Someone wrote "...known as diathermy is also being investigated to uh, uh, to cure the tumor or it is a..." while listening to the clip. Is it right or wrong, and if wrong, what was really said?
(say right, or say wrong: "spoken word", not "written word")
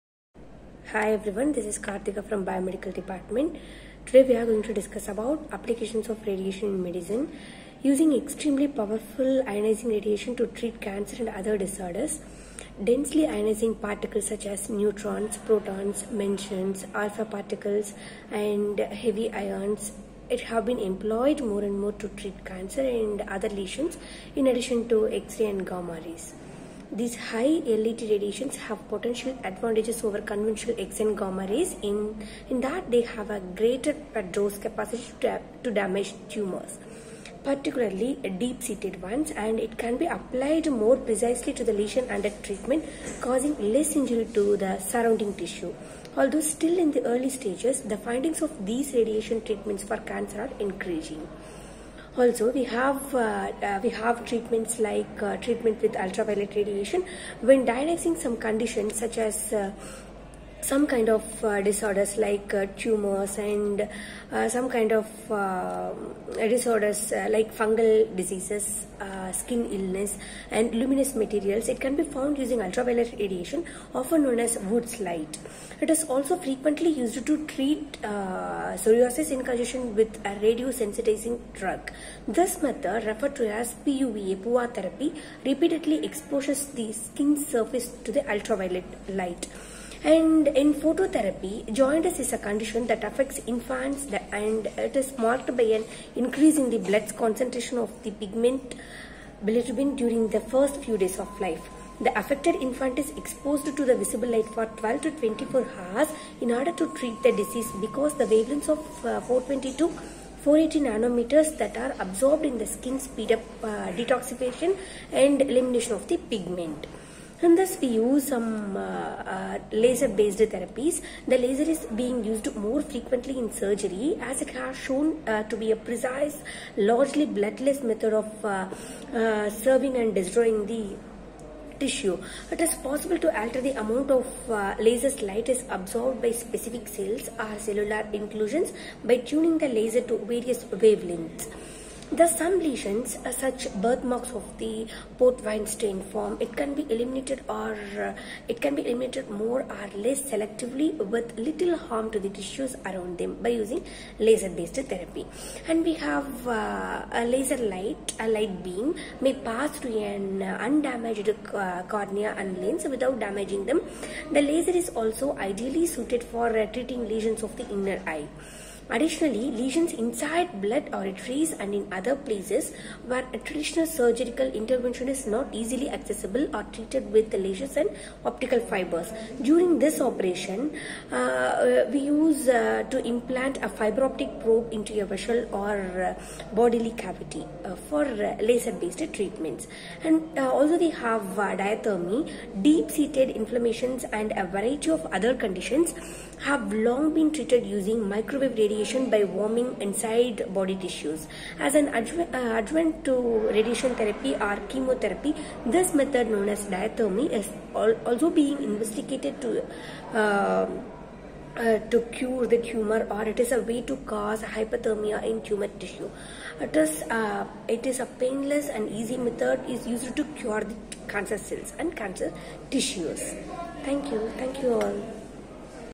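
right.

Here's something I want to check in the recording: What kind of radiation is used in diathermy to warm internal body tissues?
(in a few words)
Microwave radiation.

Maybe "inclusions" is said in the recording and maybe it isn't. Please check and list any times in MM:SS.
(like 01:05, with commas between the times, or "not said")
02:18.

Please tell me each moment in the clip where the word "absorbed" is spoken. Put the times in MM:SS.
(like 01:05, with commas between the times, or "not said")
01:51, 02:15.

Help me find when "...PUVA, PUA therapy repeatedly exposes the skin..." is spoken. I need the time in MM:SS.
01:23.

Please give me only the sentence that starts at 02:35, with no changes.
And we have uh, a laser light, a light beam may pass through an undamaged uh, cornea and lens without damaging them.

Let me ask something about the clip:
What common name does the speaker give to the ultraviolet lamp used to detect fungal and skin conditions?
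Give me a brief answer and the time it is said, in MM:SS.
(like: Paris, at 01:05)
Wood's light, at 01:14.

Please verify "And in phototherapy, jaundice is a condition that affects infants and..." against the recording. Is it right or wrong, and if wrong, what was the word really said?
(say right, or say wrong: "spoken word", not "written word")
right.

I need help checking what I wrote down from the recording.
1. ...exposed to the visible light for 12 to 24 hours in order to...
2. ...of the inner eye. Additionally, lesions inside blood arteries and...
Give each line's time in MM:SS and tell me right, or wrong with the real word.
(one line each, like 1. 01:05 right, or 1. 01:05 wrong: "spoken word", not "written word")
1. 01:43 right
2. 02:47 right.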